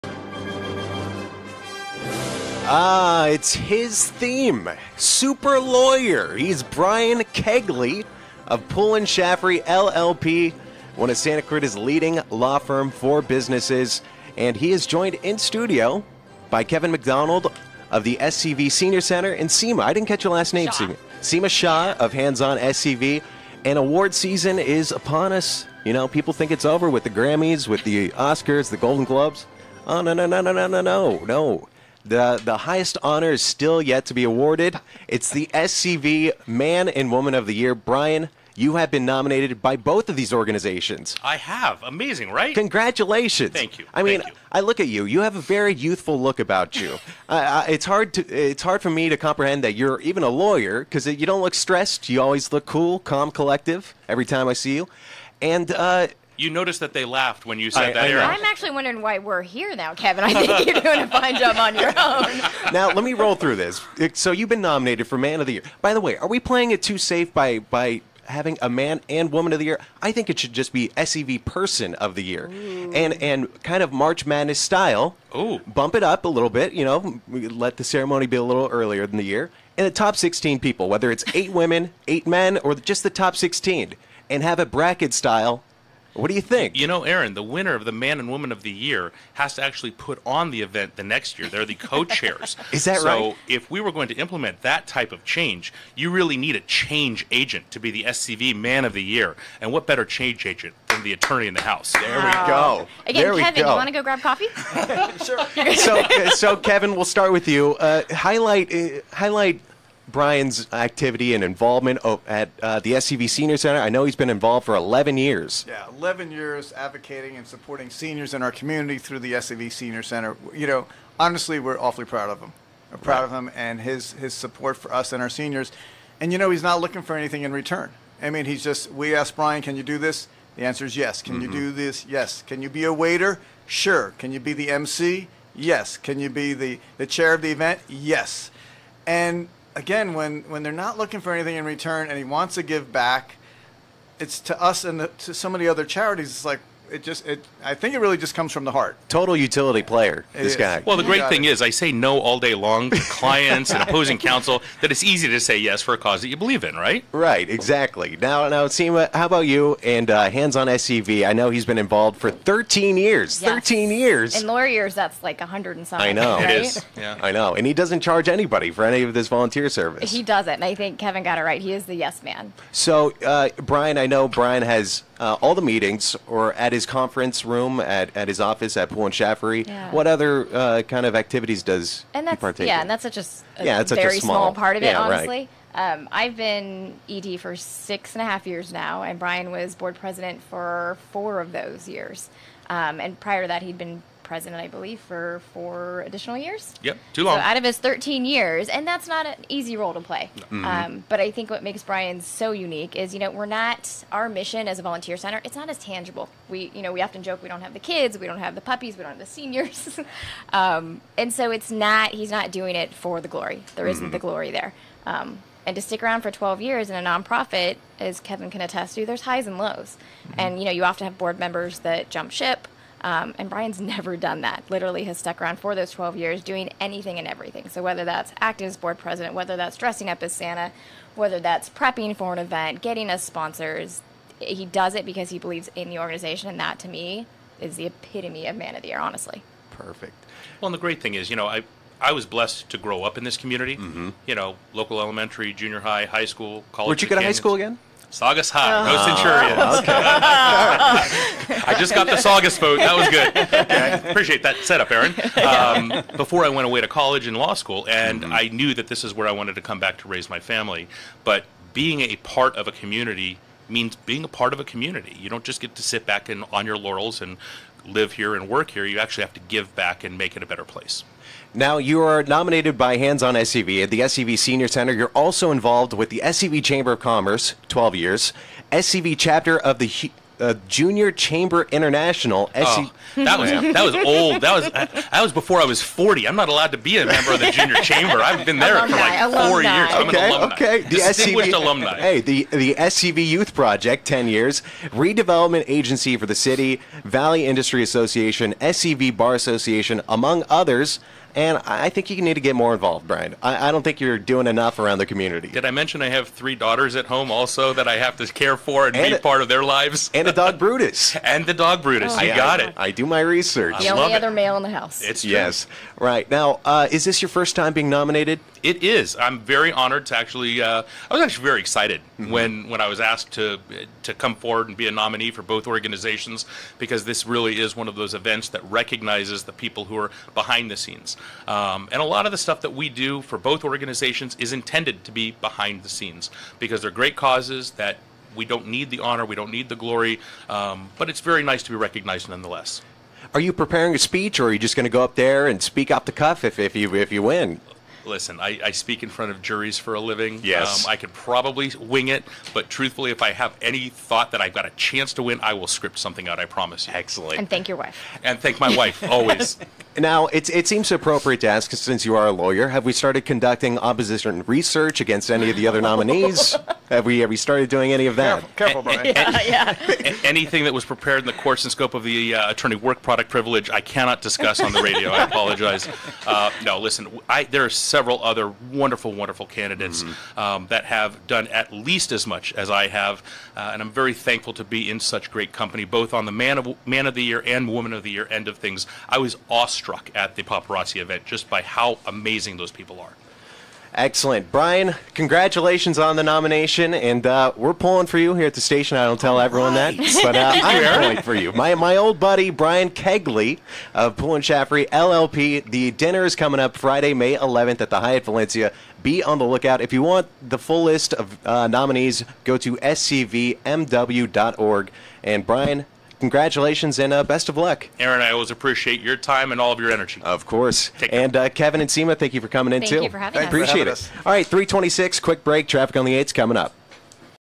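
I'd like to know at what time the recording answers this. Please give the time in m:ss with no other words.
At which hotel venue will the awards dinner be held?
6:47.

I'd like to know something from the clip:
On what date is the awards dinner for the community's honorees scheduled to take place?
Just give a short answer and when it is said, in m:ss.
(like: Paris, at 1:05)
Friday, May 11th, at 6:46.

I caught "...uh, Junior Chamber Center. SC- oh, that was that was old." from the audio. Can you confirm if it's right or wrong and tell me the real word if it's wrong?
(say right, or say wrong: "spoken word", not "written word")
wrong: "International", not "Center".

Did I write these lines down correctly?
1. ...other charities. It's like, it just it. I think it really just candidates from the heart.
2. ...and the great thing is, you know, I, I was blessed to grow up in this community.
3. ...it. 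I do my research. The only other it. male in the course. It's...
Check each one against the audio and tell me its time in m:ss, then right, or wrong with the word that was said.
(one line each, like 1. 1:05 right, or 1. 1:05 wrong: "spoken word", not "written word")
1. 2:25 wrong: "comes", not "candidates"
2. 4:00 right
3. 5:12 wrong: "house", not "course".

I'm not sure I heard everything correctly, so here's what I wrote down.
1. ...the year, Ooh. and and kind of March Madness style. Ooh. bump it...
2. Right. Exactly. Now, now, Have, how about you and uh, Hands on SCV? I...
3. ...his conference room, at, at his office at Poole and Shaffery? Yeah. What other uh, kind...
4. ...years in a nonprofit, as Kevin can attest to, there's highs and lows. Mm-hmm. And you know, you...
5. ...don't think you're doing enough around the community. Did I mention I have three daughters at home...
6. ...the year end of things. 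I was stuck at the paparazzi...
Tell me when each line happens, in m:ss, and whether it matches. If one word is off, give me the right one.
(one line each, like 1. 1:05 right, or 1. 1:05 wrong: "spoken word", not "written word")
1. 1:12 right
2. 2:37 wrong: "Seema", not "Have"
3. 2:56 right
4. 3:36 right
5. 5:03 right
6. 6:28 wrong: "awestruck", not "stuck".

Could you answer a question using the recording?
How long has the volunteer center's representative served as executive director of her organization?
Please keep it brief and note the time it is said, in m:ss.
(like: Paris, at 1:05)
Six and a half years, at 3:07.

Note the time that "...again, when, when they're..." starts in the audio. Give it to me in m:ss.
2:19.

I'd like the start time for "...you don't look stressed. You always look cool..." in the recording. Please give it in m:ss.
0:51.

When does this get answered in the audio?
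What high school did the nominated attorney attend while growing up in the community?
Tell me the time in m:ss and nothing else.
4:08.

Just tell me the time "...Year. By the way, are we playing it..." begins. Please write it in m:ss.
1:05.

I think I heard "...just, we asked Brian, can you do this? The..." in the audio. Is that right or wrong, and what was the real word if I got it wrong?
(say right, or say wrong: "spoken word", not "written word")
right.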